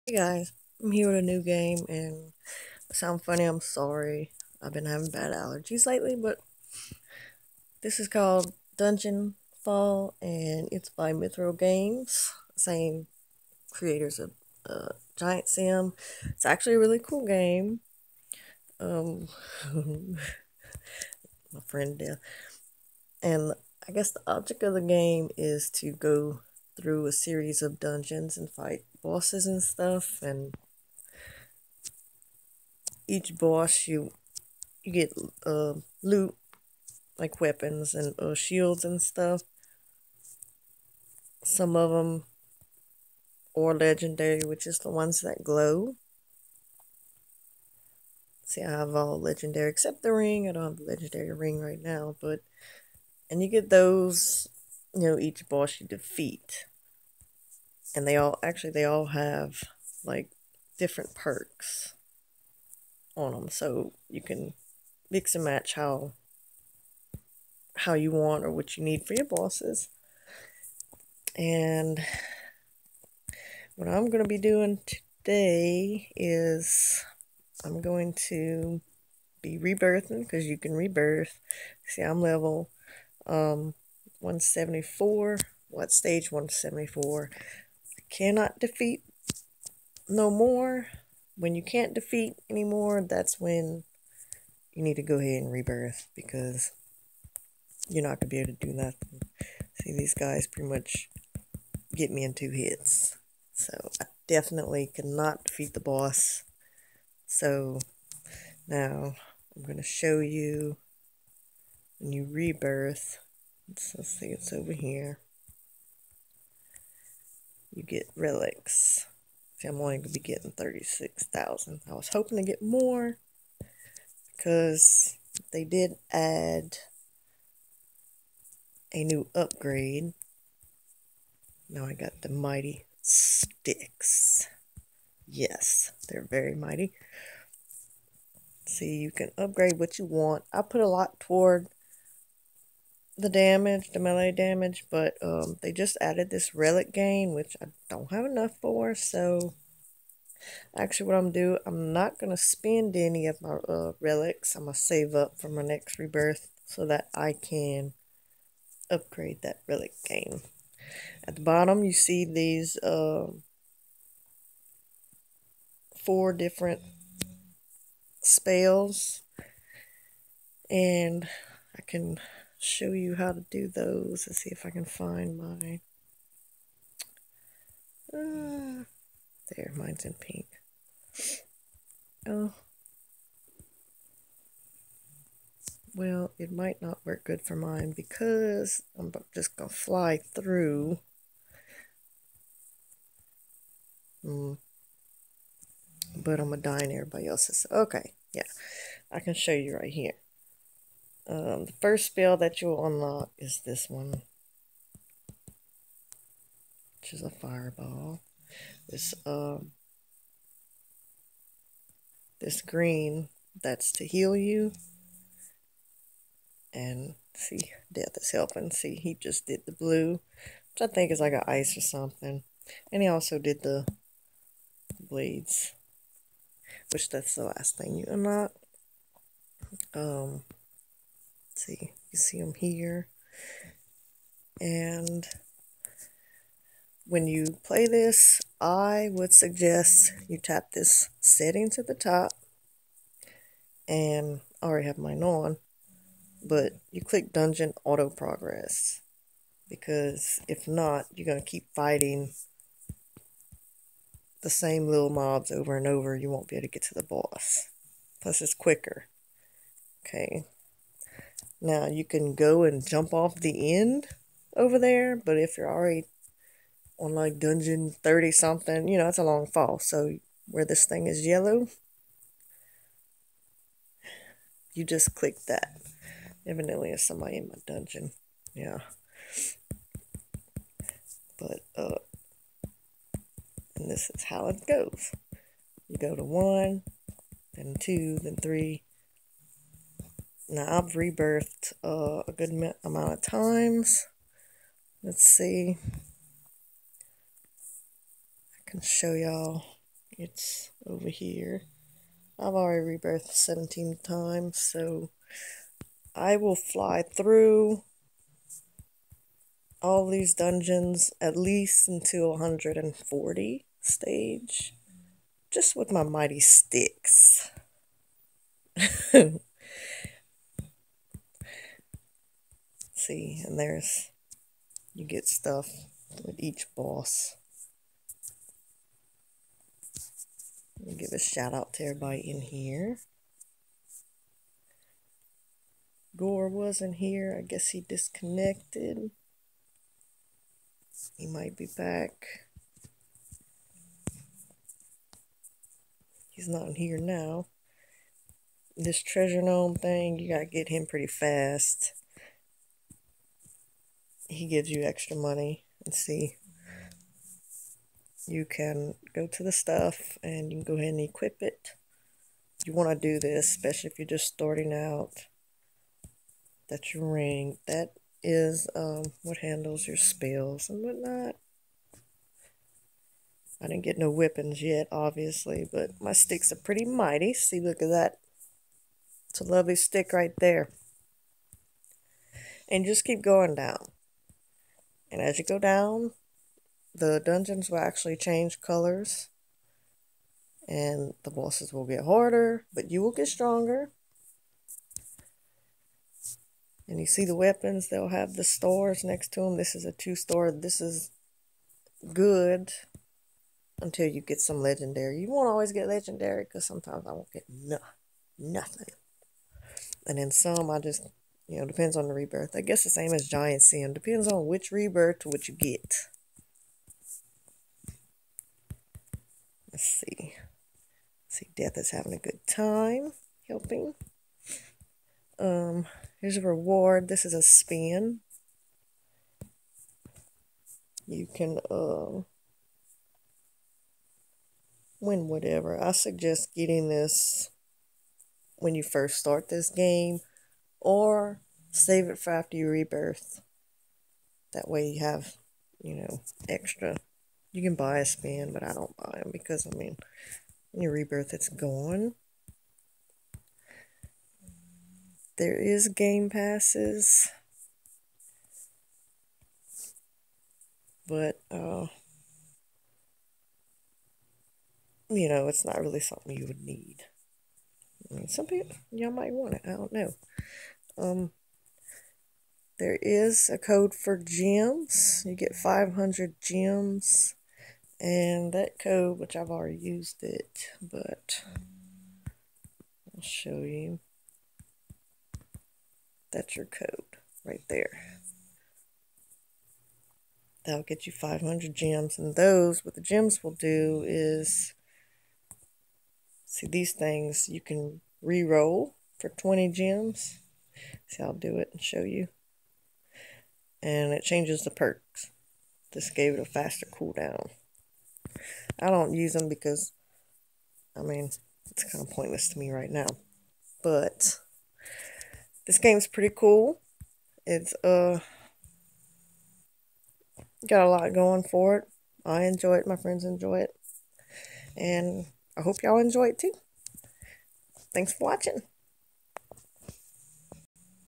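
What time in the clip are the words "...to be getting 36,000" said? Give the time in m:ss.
2:00.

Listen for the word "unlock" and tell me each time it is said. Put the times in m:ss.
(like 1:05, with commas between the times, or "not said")
3:22, 3:48.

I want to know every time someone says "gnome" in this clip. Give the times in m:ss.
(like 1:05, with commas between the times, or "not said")
5:49.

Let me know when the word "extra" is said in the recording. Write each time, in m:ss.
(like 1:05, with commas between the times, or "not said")
5:54, 7:26.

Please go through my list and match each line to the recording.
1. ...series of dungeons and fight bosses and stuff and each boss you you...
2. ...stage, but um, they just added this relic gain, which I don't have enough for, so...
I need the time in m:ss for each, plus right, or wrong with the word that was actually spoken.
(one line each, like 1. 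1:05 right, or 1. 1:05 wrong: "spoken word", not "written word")
1. 0:27 right
2. 2:24 wrong: "damage", not "stage".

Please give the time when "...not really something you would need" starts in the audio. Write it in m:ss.
7:45.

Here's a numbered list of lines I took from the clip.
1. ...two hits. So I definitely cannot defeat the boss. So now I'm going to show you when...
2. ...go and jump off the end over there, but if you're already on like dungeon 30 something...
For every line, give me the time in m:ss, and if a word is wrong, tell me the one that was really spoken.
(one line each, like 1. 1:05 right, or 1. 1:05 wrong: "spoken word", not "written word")
1. 1:42 right
2. 4:22 right.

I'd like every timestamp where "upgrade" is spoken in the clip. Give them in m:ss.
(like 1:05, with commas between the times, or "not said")
2:09, 2:19, 2:38.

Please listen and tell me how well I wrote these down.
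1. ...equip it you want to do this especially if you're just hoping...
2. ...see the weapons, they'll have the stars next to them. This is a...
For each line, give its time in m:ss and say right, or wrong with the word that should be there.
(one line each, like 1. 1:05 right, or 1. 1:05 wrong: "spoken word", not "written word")
1. 6:01 wrong: "starting", not "hoping"
2. 6:37 right.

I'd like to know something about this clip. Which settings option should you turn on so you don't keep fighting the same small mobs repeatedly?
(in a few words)
Dungeon Auto Progress.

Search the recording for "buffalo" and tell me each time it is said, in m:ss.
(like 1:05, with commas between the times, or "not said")
not said.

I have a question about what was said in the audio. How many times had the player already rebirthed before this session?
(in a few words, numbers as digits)
17.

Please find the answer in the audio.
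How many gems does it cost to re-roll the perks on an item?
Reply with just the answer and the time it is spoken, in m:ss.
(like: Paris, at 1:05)
20, at 8:19.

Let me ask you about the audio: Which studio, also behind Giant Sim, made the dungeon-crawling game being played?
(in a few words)
Mithril Games.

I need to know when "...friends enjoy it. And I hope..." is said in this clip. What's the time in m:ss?
8:42.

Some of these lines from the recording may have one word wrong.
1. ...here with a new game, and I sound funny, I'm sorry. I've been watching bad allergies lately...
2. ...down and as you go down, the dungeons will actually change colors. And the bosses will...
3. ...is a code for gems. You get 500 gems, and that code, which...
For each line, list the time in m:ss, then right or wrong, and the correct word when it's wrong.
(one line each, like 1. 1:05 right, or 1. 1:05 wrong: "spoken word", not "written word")
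1. 0:00 wrong: "having", not "watching"
2. 6:23 right
3. 7:53 right.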